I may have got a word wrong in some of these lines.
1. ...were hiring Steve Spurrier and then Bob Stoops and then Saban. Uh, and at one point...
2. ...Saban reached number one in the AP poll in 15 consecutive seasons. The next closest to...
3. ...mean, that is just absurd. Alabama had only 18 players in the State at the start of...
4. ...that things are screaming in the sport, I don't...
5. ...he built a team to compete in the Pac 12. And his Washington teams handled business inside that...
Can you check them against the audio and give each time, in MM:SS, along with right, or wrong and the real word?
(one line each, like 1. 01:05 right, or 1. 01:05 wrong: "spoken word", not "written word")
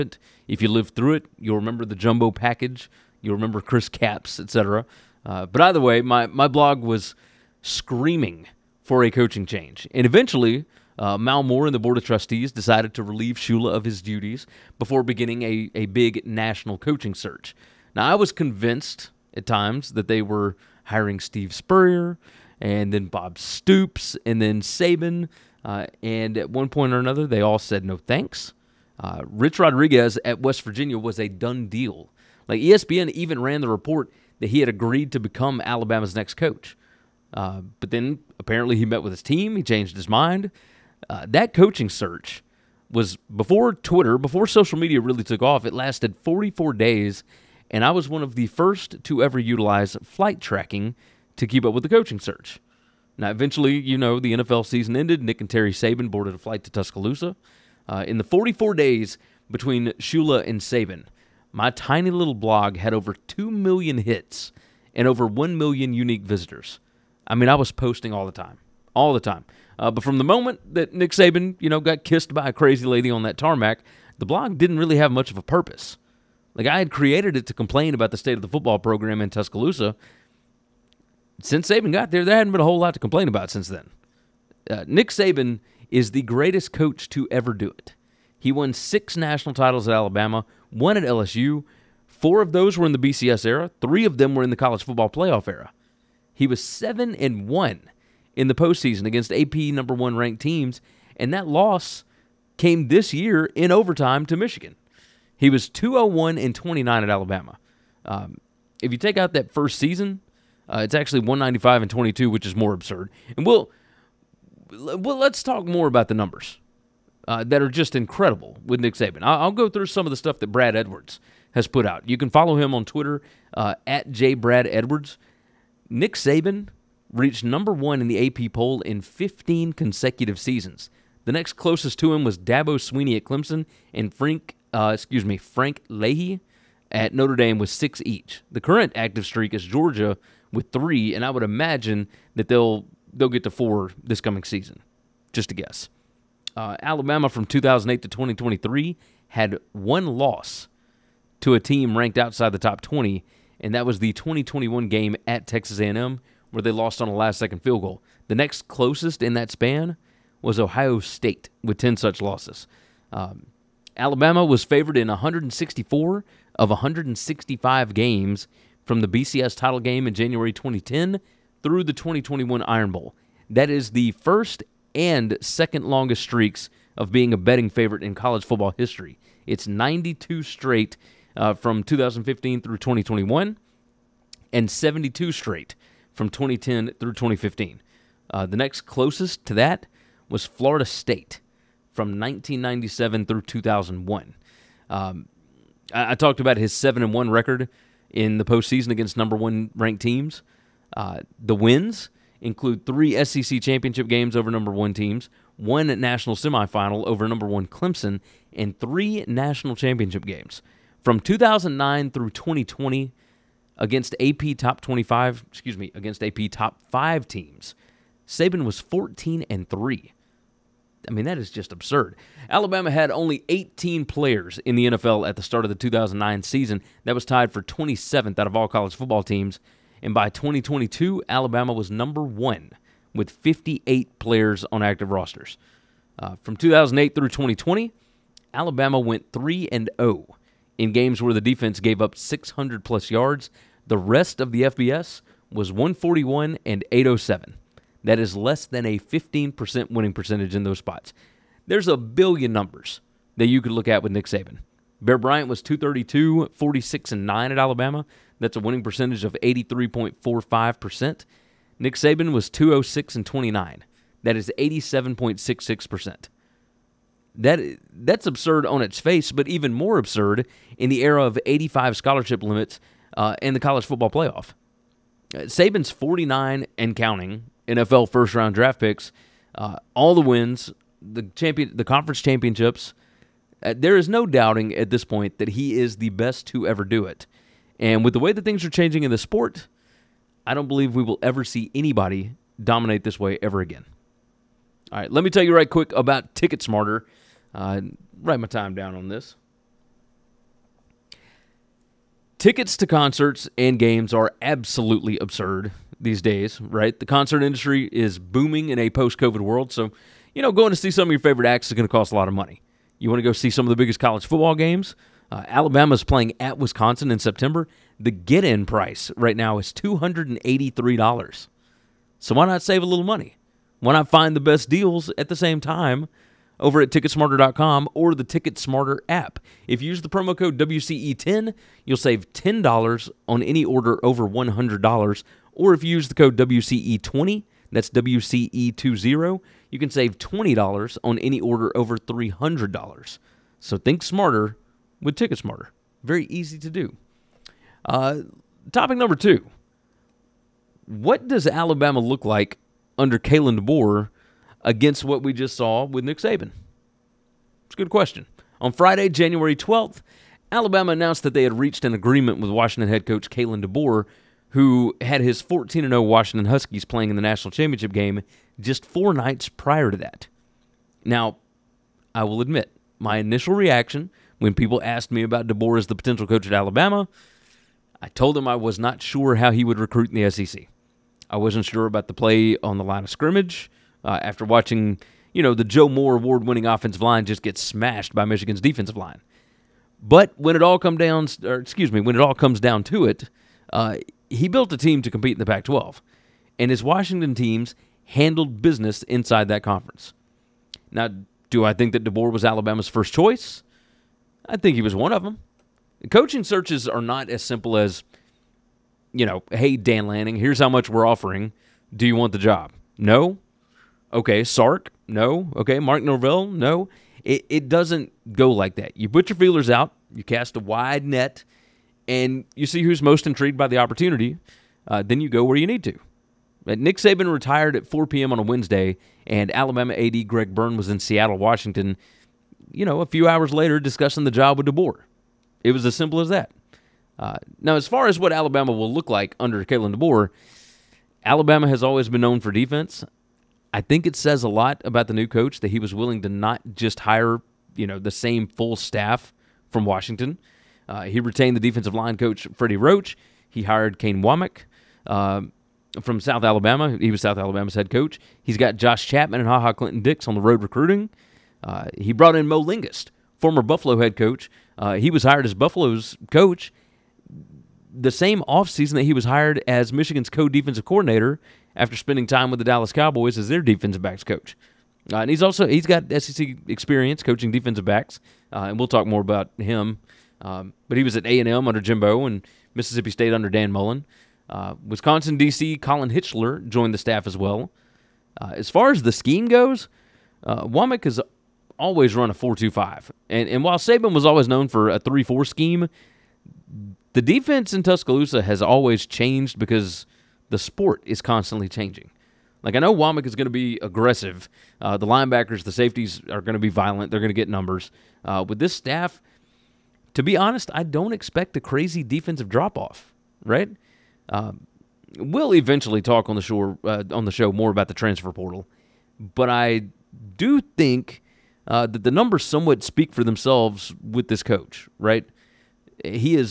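1. 00:20 right
2. 02:06 right
3. 03:41 wrong: "NFL", not "State"
4. 04:48 wrong: "changing", not "screaming"
5. 06:34 right.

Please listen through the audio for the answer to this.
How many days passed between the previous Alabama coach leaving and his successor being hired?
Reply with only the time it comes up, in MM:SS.
00:45.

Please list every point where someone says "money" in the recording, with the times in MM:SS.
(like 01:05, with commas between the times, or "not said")
05:12, 05:23.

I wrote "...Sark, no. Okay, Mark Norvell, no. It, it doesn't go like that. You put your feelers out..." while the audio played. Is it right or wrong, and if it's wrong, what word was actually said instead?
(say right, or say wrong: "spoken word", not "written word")
right.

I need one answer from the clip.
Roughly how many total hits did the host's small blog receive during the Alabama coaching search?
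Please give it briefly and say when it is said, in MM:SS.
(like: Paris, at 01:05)
2 million, at 01:02.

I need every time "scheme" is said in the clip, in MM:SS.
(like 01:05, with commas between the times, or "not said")
08:09, 08:15.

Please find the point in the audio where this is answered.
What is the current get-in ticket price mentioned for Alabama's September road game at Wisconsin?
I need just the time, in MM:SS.
05:19.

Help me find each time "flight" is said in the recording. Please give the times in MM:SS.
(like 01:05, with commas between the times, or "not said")
00:50, 00:56.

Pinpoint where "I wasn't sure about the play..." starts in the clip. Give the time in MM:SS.
06:21.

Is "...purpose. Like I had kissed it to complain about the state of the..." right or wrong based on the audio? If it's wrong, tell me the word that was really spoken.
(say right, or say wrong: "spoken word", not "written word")
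wrong: "created", not "kissed".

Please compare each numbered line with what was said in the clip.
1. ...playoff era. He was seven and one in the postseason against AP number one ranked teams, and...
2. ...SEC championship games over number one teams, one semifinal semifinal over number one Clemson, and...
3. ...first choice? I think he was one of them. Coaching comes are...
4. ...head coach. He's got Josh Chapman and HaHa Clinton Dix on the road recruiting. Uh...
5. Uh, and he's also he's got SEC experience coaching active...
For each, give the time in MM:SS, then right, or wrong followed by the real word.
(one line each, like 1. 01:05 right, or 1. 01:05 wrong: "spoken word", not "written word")
1. 01:35 right
2. 03:23 wrong: "national", not "semifinal"
3. 06:42 wrong: "searches", not "comes"
4. 07:37 right
5. 07:55 wrong: "defensive", not "active".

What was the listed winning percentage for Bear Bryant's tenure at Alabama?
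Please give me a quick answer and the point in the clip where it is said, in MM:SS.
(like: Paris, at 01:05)
83.45%, at 04:19.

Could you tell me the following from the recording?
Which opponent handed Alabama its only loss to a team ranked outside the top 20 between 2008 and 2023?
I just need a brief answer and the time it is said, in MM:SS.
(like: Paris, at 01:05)
Texas A&M, at 02:35.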